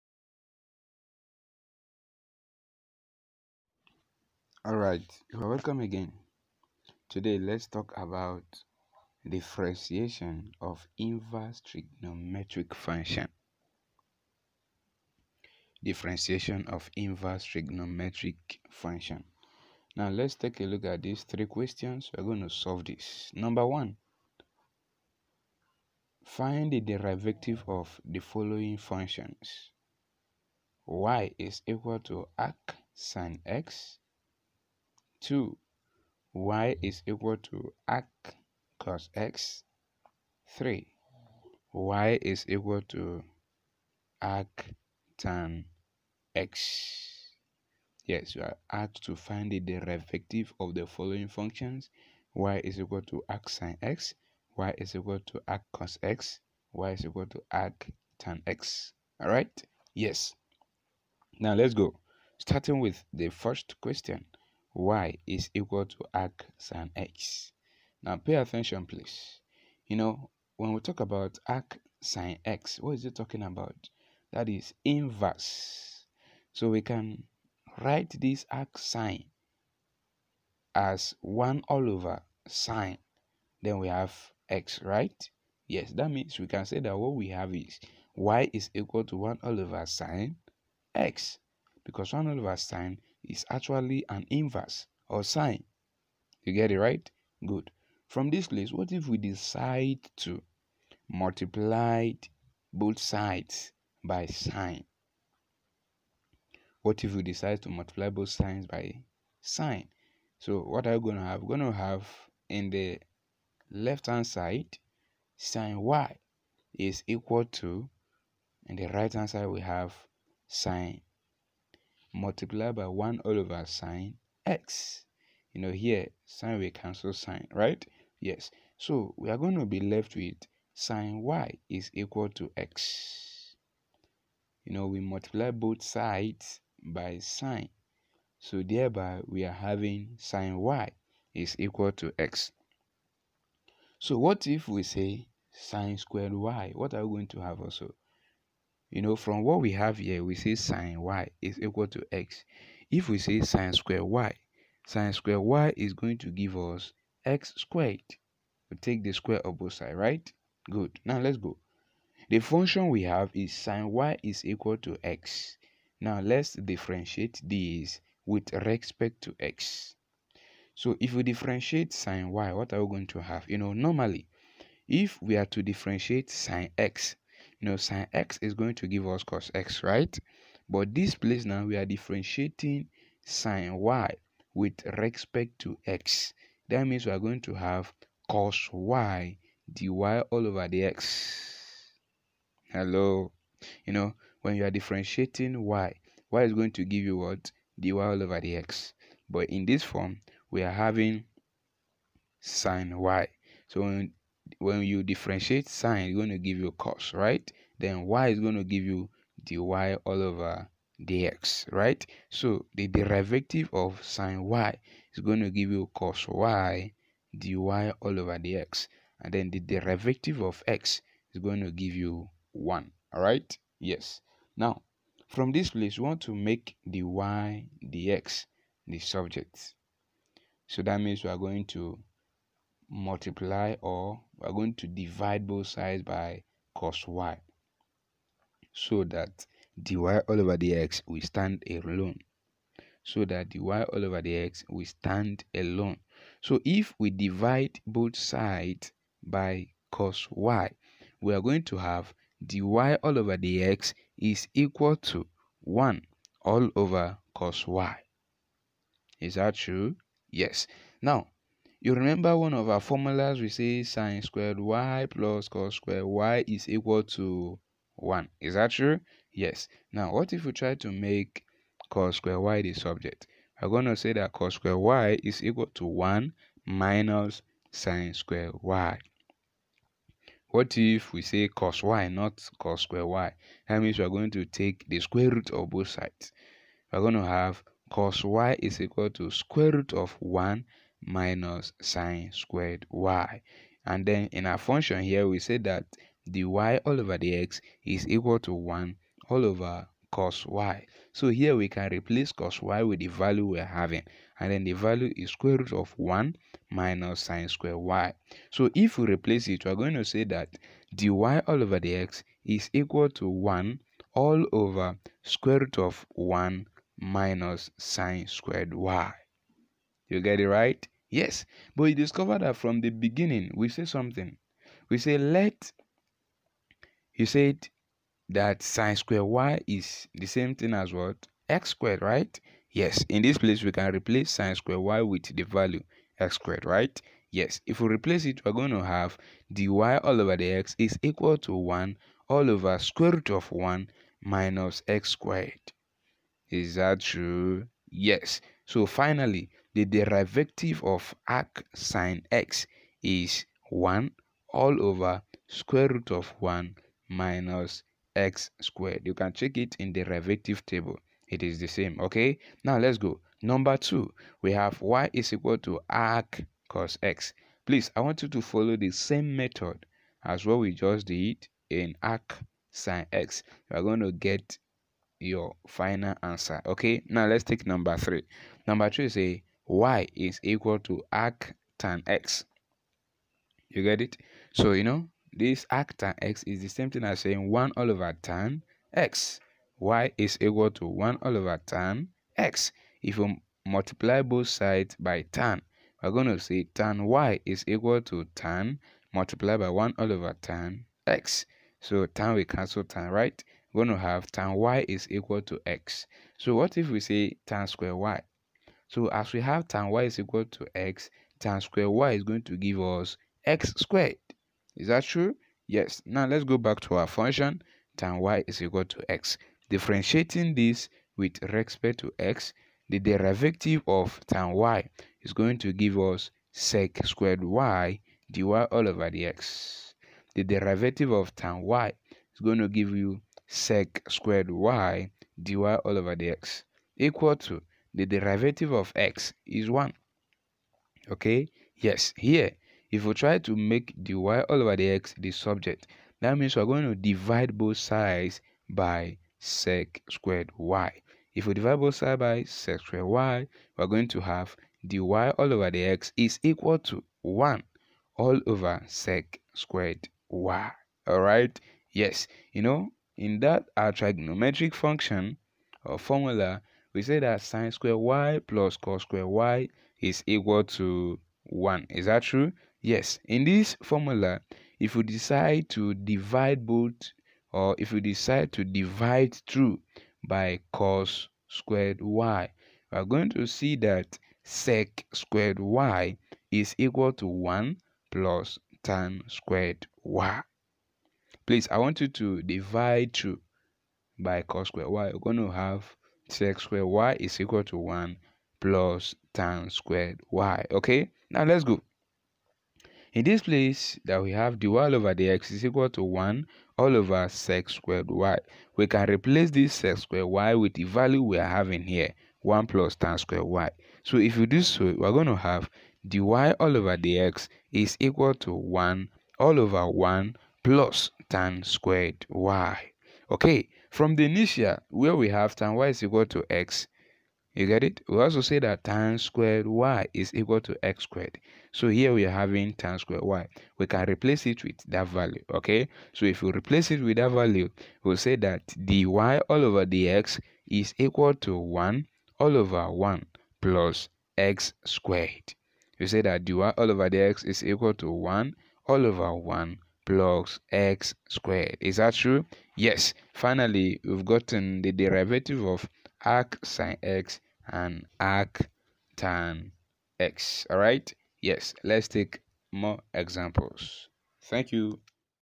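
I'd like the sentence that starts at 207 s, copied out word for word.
Then y is going to give you dy all over dx, right?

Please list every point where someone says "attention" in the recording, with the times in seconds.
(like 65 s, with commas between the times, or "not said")
68 s.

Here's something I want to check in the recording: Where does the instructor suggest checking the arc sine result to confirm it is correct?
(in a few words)
derivative table.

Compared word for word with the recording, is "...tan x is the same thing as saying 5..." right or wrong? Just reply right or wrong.
wrong.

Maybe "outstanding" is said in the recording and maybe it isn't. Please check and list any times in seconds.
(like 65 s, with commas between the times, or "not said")
not said.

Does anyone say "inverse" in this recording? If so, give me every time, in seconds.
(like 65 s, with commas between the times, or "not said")
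10 s, 16 s, 74 s, 94 s.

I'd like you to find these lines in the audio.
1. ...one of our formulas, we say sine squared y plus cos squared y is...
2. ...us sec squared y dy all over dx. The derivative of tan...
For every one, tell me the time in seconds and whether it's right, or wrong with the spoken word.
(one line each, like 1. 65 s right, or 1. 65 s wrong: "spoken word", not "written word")
1. 262 s right
2. 425 s right.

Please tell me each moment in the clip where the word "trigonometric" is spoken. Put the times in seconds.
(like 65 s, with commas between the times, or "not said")
11 s, 17 s, 463 s.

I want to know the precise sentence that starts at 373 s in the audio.
You are going to get your final answer, okay?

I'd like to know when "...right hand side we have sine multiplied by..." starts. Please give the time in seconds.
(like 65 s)
118 s.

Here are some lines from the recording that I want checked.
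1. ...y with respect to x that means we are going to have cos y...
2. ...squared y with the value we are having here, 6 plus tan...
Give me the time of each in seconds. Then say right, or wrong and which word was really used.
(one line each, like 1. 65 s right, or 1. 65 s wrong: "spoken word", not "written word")
1. 183 s right
2. 509 s wrong: "1", not "6".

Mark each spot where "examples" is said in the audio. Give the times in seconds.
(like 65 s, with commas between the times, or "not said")
563 s.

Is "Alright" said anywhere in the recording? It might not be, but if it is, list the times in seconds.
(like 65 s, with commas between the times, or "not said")
59 s, 461 s.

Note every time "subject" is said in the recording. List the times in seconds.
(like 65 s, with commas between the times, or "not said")
228 s, 272 s, 445 s.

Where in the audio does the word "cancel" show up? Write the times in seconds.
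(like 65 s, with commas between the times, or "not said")
126 s, 402 s.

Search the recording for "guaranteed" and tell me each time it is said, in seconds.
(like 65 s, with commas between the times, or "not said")
not said.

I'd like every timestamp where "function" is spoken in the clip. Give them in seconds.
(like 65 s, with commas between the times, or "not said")
12 s, 18 s, 28 s, 51 s, 162 s, 294 s, 417 s, 464 s.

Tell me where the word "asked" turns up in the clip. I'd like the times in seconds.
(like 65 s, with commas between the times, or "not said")
48 s.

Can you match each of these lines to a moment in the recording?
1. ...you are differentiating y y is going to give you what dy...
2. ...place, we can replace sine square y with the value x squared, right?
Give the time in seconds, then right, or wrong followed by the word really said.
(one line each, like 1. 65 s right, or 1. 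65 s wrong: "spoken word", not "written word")
1. 194 s right
2. 333 s right.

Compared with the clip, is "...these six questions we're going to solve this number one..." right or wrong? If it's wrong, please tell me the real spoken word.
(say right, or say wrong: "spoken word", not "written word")
wrong: "three", not "six".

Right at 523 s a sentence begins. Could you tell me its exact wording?
Okay, from the initial where we have tan y is equal to x, you get it?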